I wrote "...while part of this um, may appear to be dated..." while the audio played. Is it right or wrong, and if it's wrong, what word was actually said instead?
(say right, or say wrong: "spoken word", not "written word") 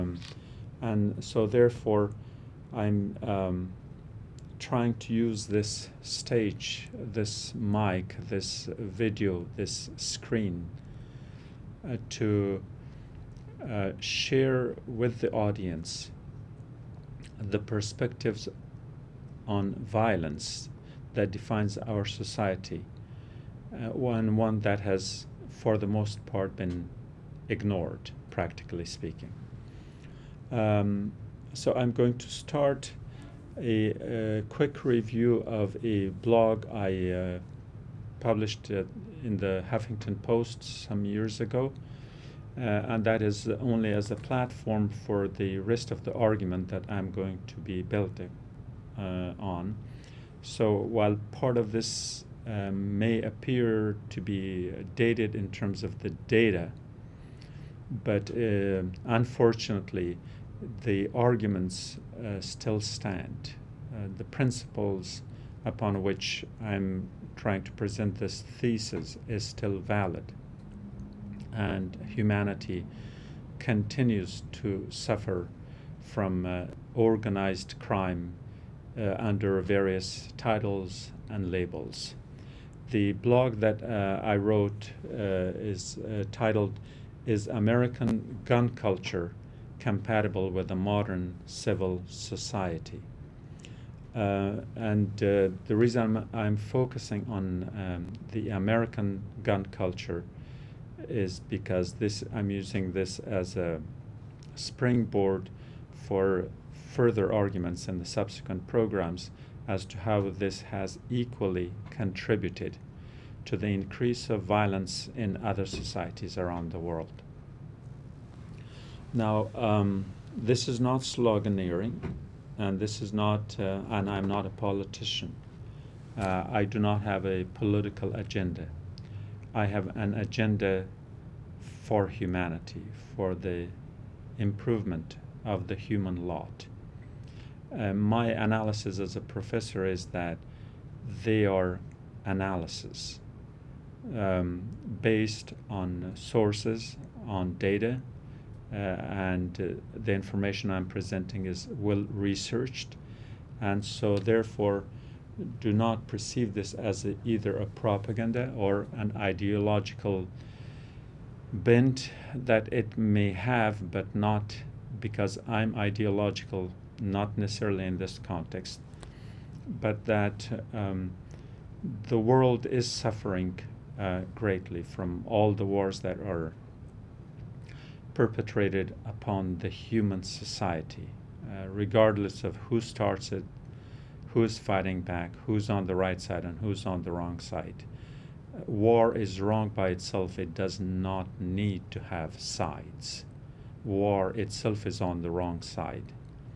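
right.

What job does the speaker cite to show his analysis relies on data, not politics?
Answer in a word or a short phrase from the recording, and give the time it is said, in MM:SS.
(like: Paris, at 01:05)
professor, at 02:19.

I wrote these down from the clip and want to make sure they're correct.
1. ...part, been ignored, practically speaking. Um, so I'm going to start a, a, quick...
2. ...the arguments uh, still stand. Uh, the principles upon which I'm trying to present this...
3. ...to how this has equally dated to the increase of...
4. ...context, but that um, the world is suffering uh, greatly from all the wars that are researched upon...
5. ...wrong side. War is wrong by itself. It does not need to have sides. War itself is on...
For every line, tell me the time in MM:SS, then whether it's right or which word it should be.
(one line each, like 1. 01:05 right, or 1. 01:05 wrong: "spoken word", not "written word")
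1. 00:26 right
2. 01:00 right
3. 01:49 wrong: "contributed", not "dated"
4. 02:48 wrong: "perpetrated", not "researched"
5. 03:07 right.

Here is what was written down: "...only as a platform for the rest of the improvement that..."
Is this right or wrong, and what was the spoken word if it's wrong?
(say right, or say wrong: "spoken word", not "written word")
wrong: "argument", not "improvement".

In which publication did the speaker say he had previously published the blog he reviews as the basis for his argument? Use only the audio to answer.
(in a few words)
Huffington Post.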